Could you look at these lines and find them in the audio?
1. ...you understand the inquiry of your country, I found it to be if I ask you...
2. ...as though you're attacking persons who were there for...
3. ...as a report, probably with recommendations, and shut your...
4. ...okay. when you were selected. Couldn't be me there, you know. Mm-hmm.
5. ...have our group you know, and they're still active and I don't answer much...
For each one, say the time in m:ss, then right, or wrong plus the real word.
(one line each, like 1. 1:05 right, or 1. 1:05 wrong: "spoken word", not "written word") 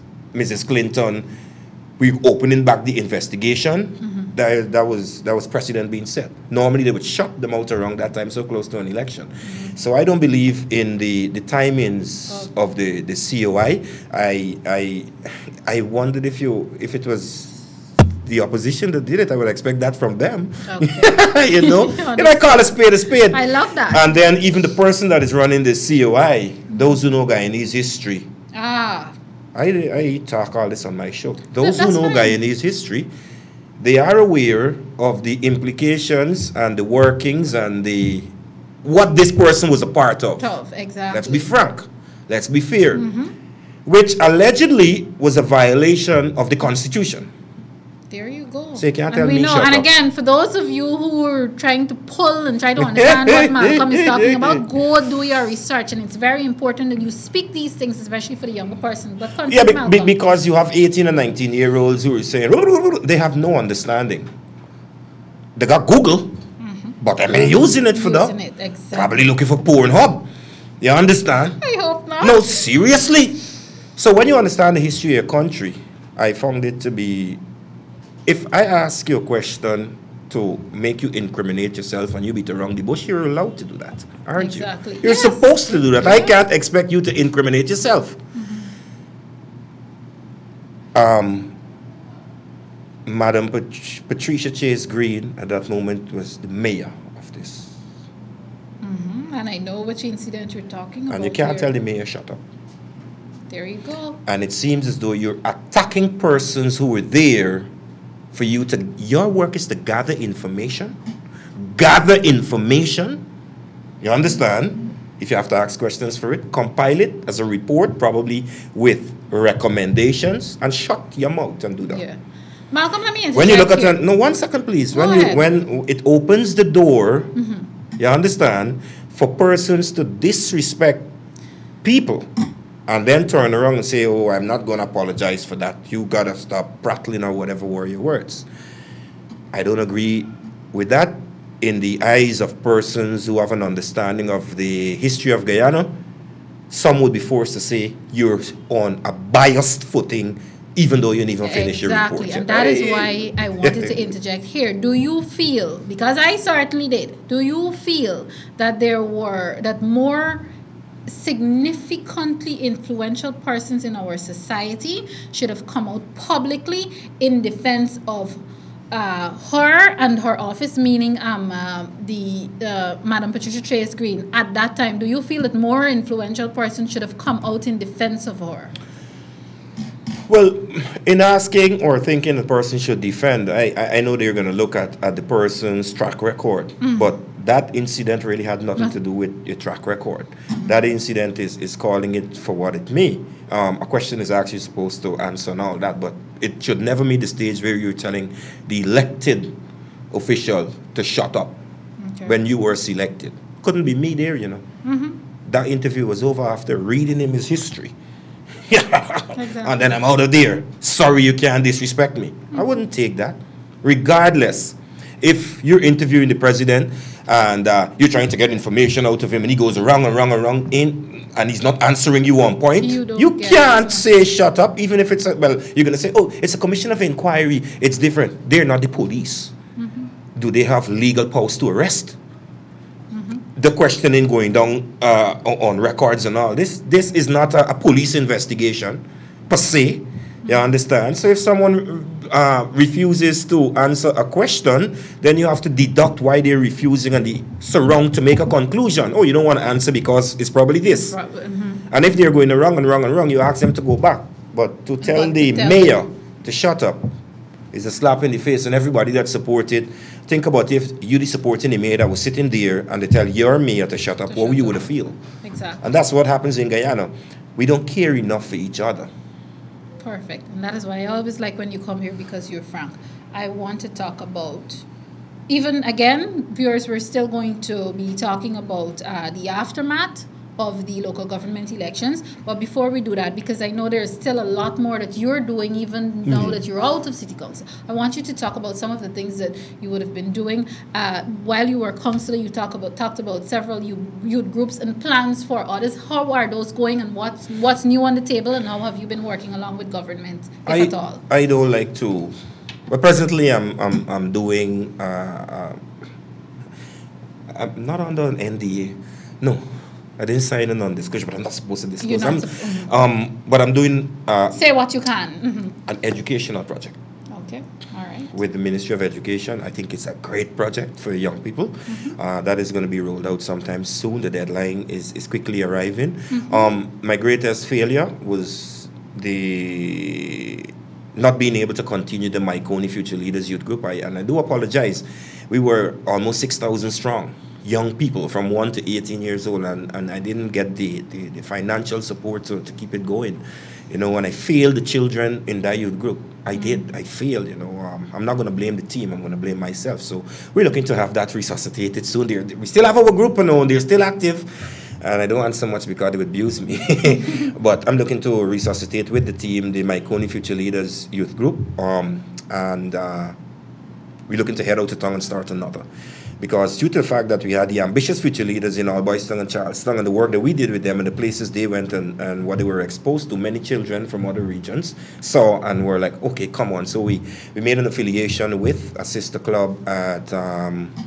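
1. 1:14 wrong: "history", not "inquiry"
2. 1:44 right
3. 1:57 right
4. 3:22 right
5. 5:52 right.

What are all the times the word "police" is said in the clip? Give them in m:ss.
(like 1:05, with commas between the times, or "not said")
3:48, 3:57.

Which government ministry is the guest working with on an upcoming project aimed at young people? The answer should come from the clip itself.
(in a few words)
Ministry of Education.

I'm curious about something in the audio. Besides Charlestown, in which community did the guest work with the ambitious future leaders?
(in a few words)
Albouystown.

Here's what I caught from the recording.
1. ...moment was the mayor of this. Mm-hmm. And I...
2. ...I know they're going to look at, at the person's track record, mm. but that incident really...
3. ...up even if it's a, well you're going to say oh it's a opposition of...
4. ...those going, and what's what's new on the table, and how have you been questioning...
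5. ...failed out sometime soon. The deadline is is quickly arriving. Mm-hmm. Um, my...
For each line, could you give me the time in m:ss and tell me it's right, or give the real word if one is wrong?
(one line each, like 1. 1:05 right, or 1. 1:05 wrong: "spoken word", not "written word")
1. 1:35 right
2. 3:03 right
3. 3:44 wrong: "commission", not "opposition"
4. 4:56 wrong: "working", not "questioning"
5. 5:22 wrong: "rolled", not "failed".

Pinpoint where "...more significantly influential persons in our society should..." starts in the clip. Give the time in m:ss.
2:39.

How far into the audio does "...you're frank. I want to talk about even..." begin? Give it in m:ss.
4:32.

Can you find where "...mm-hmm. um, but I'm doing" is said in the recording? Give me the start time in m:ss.
5:12.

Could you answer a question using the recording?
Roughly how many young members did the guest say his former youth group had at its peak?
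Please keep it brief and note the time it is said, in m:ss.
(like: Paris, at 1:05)
6,000, at 5:36.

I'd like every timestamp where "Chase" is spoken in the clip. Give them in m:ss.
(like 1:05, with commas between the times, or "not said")
1:34, 2:53.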